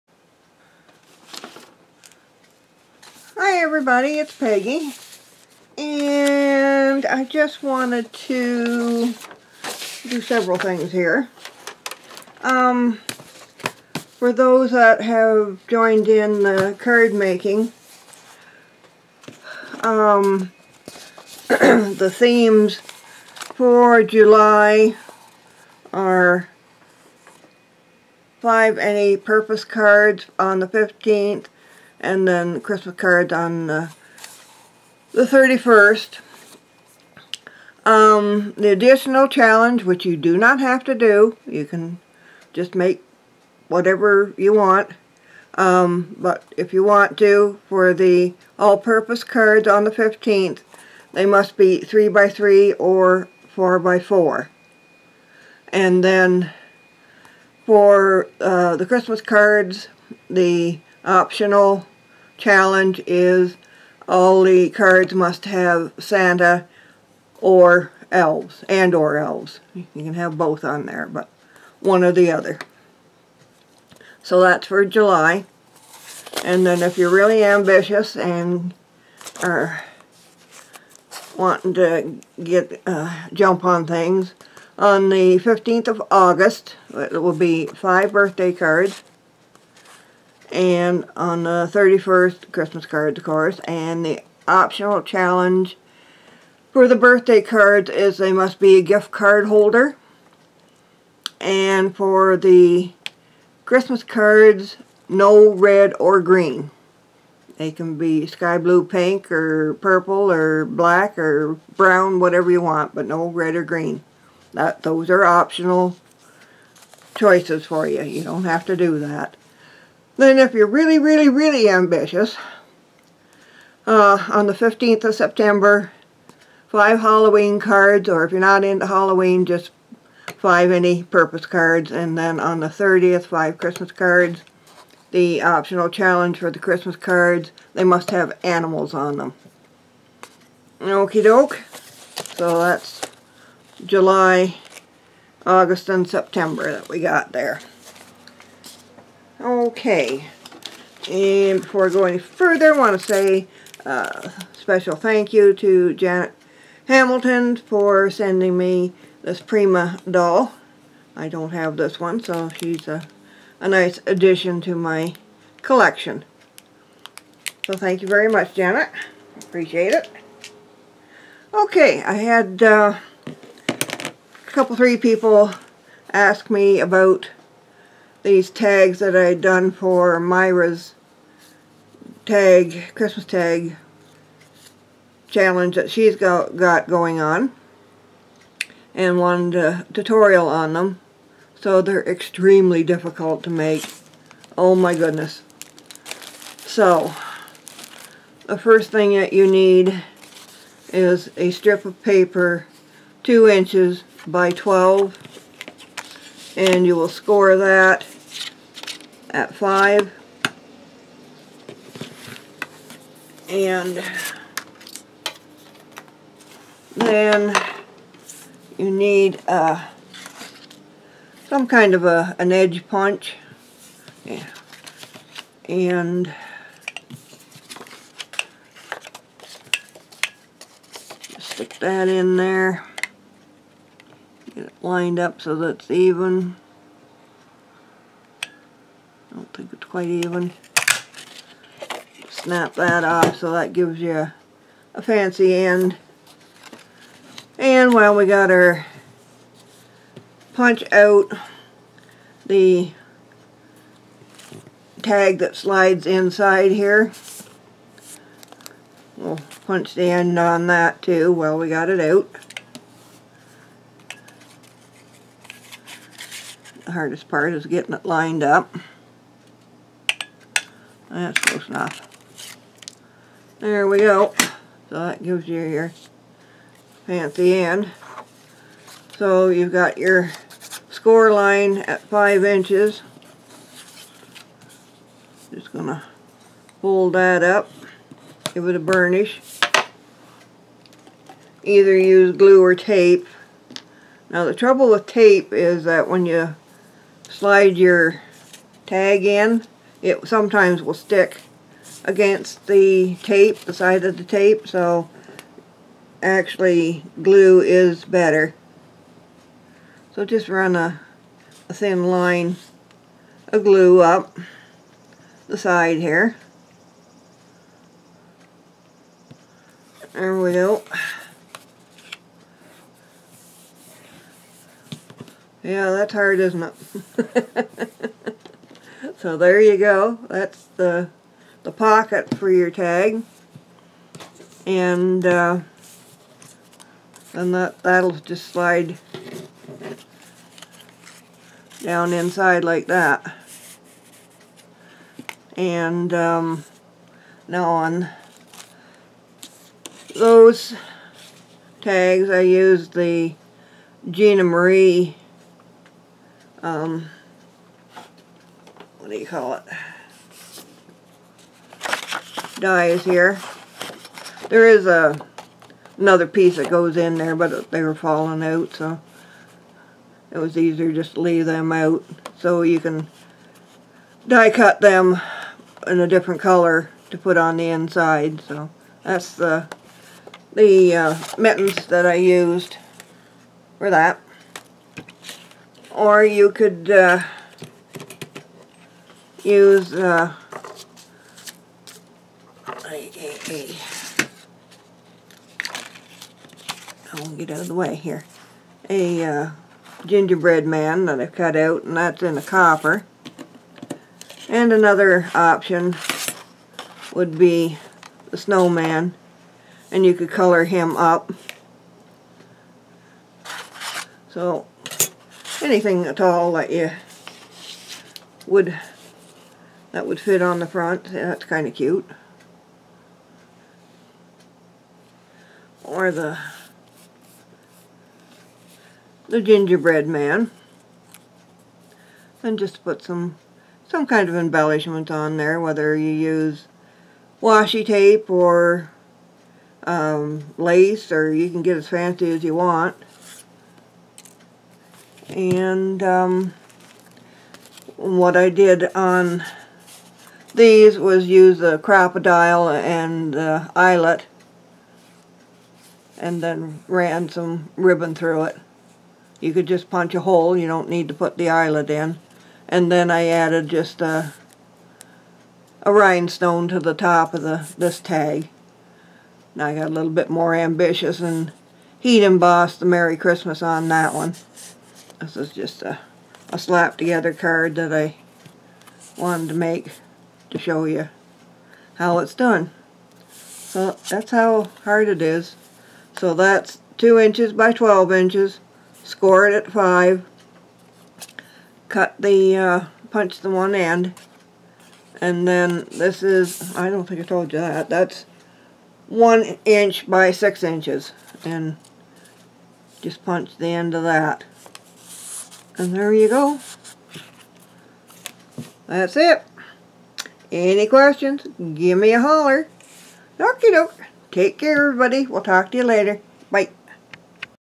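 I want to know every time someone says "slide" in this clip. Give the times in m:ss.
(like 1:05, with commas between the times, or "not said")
4:15, 4:57, 5:38.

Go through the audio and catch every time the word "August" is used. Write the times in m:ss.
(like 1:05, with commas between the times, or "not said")
1:26, 2:25.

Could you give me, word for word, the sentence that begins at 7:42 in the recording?
And then I added just a, a rhinestone to the top of the this tag.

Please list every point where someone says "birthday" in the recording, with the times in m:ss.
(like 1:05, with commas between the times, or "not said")
1:28, 1:36.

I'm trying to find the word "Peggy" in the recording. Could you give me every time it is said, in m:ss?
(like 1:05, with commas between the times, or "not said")
0:04.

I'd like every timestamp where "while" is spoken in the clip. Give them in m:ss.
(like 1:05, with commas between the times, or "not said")
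4:07, 4:21.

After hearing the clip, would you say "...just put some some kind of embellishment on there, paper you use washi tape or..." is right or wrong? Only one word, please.
wrong.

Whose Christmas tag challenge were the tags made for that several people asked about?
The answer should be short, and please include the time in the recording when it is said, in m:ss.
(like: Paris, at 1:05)
Myra, at 3:00.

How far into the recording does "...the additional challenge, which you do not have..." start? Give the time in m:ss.
0:38.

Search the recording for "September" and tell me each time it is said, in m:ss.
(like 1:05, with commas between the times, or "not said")
2:05, 2:26.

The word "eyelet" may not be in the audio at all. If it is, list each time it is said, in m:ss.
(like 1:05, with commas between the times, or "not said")
7:33, 7:41.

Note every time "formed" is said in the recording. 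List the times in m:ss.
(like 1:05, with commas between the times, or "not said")
not said.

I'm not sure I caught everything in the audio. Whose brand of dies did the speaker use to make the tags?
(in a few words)
Gina Marie.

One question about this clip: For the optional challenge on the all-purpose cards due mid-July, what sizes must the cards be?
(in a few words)
3 by 3 or 4 by 4.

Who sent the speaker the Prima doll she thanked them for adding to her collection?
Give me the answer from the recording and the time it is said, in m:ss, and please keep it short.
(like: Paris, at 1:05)
Janet Hamilton, at 2:35.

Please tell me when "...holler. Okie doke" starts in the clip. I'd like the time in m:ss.
8:32.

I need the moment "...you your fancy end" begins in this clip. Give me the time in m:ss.
4:35.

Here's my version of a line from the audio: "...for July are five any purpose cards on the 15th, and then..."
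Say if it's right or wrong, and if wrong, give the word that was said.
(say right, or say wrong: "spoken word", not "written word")
right.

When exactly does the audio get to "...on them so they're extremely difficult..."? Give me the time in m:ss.
3:10.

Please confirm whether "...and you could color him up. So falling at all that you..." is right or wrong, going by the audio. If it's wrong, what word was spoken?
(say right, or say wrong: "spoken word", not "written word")
wrong: "anything", not "falling".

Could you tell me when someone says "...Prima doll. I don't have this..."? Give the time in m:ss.
2:39.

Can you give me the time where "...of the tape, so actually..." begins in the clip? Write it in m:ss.
5:04.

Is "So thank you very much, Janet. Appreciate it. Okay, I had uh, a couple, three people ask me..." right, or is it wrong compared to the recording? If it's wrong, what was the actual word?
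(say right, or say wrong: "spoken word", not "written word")
right.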